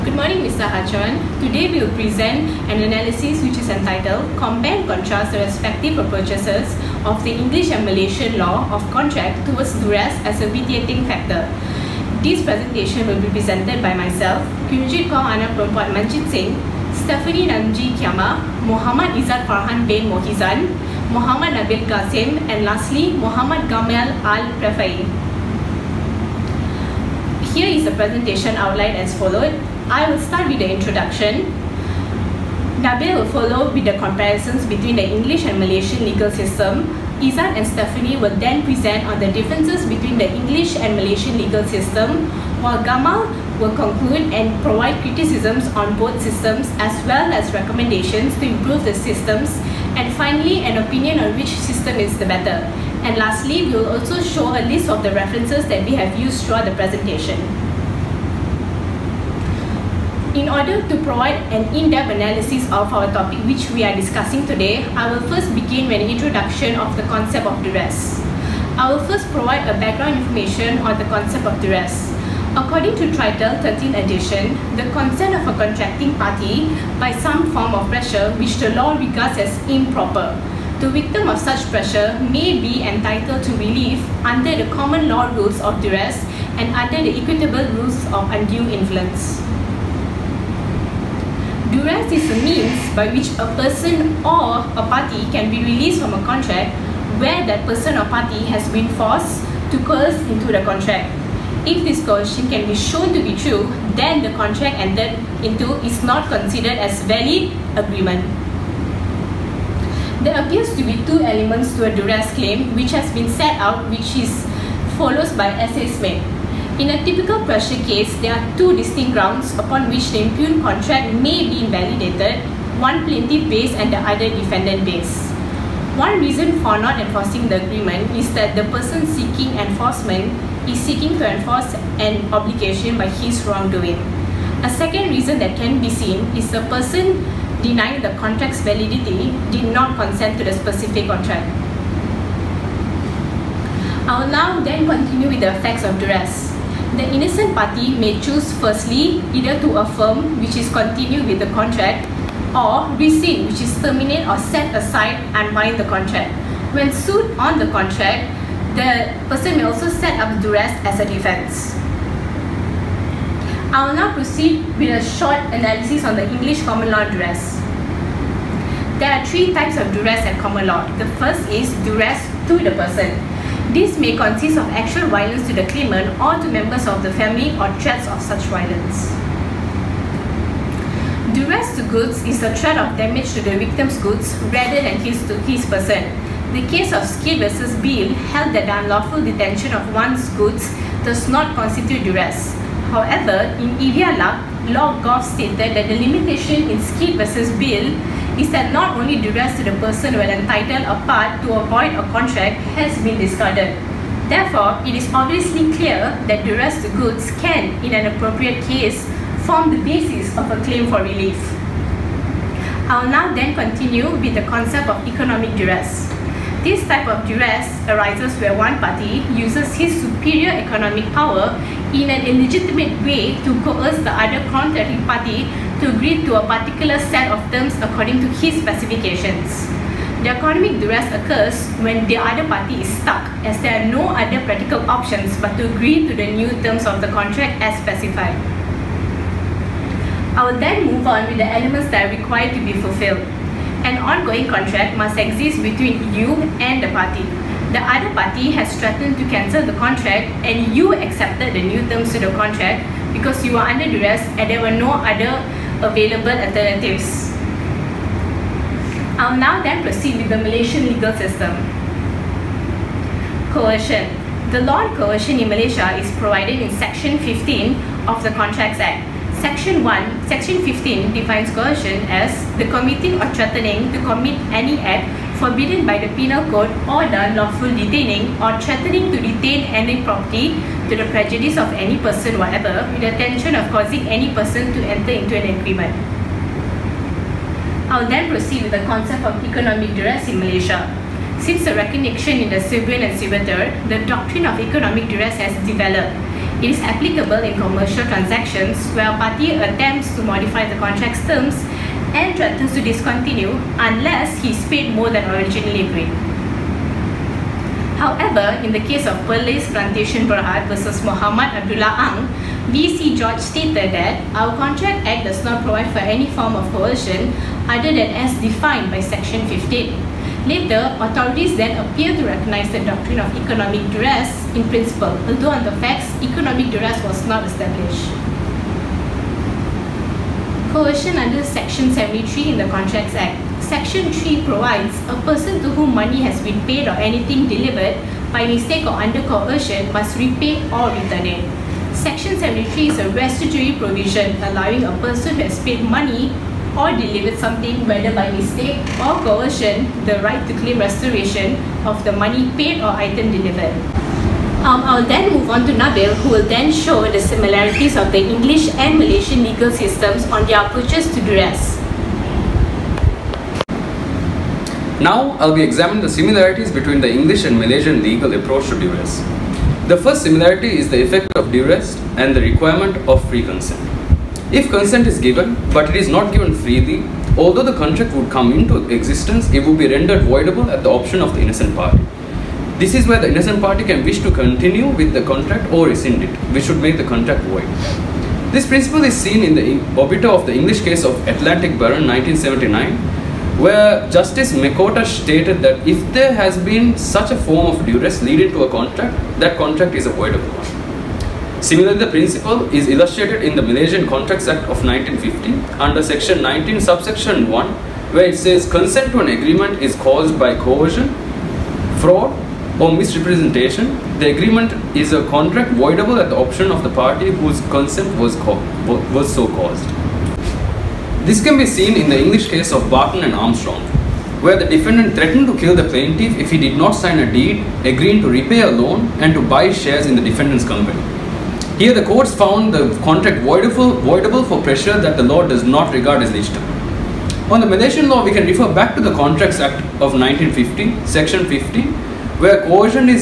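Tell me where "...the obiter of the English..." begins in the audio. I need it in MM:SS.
06:29.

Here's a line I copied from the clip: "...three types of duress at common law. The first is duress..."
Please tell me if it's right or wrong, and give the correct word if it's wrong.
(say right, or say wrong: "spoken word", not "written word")
right.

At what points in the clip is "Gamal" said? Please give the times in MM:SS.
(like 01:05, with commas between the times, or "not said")
00:23, 00:42.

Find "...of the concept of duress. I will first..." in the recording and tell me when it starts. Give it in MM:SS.
01:06.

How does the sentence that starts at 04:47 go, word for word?
I'll then proceed with the concept of economic duress in Malaysia.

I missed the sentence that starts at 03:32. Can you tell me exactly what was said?
I'll now then continue with the concept of economic duress.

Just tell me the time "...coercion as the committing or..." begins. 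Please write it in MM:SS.
04:31.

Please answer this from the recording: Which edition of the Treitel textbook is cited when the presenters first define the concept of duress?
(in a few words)
13th edition.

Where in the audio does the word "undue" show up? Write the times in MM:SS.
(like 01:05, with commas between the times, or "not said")
01:28.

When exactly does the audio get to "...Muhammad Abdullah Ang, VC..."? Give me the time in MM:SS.
05:11.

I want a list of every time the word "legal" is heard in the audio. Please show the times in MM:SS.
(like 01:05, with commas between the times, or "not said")
00:36, 00:41, 04:20, 05:59, 06:08.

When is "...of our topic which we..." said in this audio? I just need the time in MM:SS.
01:02.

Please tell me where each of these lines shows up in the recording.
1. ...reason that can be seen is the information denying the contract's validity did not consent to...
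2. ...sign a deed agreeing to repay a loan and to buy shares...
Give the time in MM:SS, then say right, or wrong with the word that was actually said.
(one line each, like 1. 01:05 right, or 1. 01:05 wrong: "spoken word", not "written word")
1. 02:15 wrong: "person", not "information"
2. 07:06 right.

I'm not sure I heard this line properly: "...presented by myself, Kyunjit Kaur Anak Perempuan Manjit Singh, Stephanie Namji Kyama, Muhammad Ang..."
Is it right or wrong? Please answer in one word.
wrong.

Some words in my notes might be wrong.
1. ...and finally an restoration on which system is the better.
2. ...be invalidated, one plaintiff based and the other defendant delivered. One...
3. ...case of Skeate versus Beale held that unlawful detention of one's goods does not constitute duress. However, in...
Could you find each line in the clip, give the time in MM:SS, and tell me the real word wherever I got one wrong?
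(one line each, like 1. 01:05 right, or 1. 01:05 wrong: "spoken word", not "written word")
1. 00:49 wrong: "opinion", not "restoration"
2. 02:01 wrong: "based", not "delivered"
3. 03:06 right.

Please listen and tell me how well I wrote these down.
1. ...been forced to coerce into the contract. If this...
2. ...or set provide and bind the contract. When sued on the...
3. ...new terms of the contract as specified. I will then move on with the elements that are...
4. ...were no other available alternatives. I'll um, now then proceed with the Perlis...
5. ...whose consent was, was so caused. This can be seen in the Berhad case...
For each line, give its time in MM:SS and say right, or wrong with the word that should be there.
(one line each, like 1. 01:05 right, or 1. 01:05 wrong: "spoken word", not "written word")
1. 01:38 right
2. 02:34 wrong: "aside", not "provide"
3. 03:56 right
4. 04:14 wrong: "Malaysian", not "Perlis"
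5. 06:57 wrong: "English", not "Berhad".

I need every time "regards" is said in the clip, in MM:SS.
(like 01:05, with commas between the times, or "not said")
01:18, 07:15.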